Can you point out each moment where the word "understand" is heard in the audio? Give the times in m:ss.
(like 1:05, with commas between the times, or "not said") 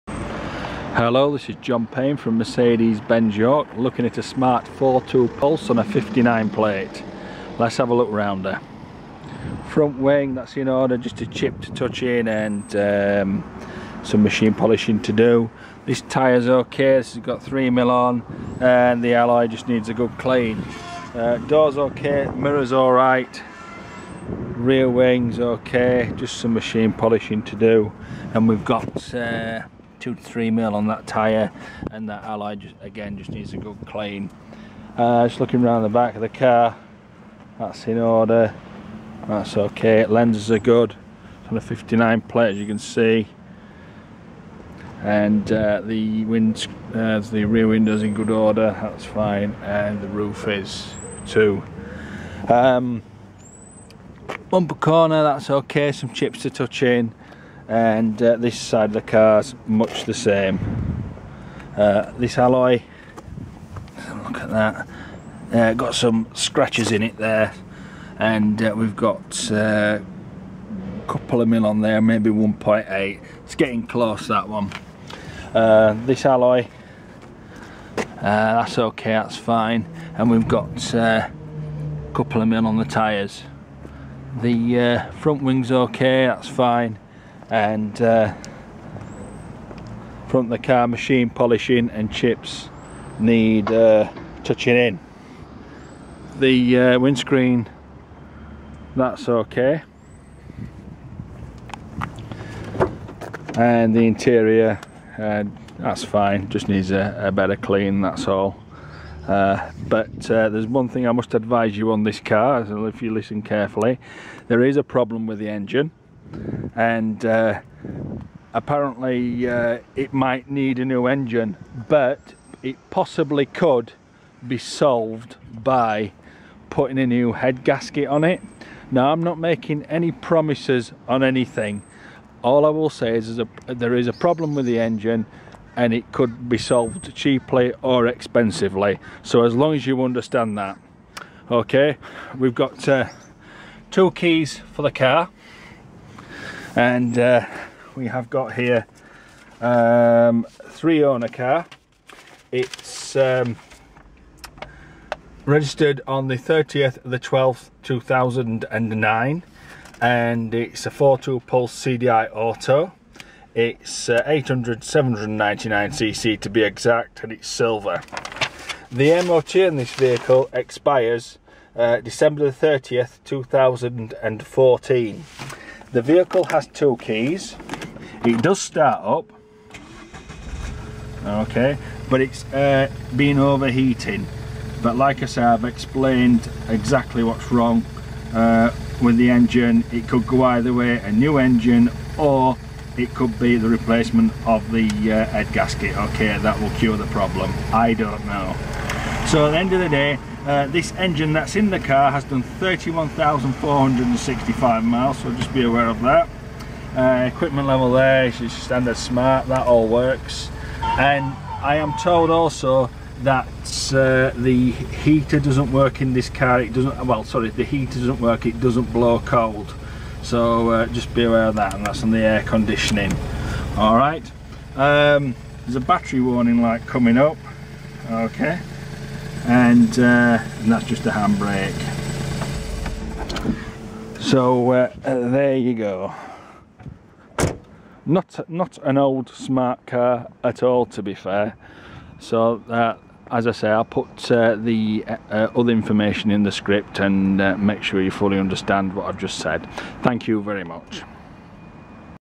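2:20, 4:08.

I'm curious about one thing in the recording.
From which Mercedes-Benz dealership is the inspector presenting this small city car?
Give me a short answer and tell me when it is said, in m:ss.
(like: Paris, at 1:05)
Mercedes-Benz York, at 0:02.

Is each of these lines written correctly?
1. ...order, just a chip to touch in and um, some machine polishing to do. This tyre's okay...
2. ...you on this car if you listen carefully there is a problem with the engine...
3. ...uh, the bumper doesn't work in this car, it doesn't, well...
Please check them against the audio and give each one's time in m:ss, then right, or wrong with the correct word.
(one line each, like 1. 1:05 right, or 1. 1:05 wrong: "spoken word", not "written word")
1. 0:10 right
2. 1:51 right
3. 3:33 wrong: "heater", not "bumper".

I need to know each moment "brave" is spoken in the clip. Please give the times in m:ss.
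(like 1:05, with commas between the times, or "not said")
not said.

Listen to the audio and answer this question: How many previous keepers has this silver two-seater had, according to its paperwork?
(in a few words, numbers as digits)
3.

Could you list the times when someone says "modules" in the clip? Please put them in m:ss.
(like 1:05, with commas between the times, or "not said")
not said.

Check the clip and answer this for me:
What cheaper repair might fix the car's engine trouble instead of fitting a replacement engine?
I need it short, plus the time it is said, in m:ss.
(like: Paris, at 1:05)
new head gasket, at 2:07.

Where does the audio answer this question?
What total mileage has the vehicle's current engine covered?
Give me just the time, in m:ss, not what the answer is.
3:22.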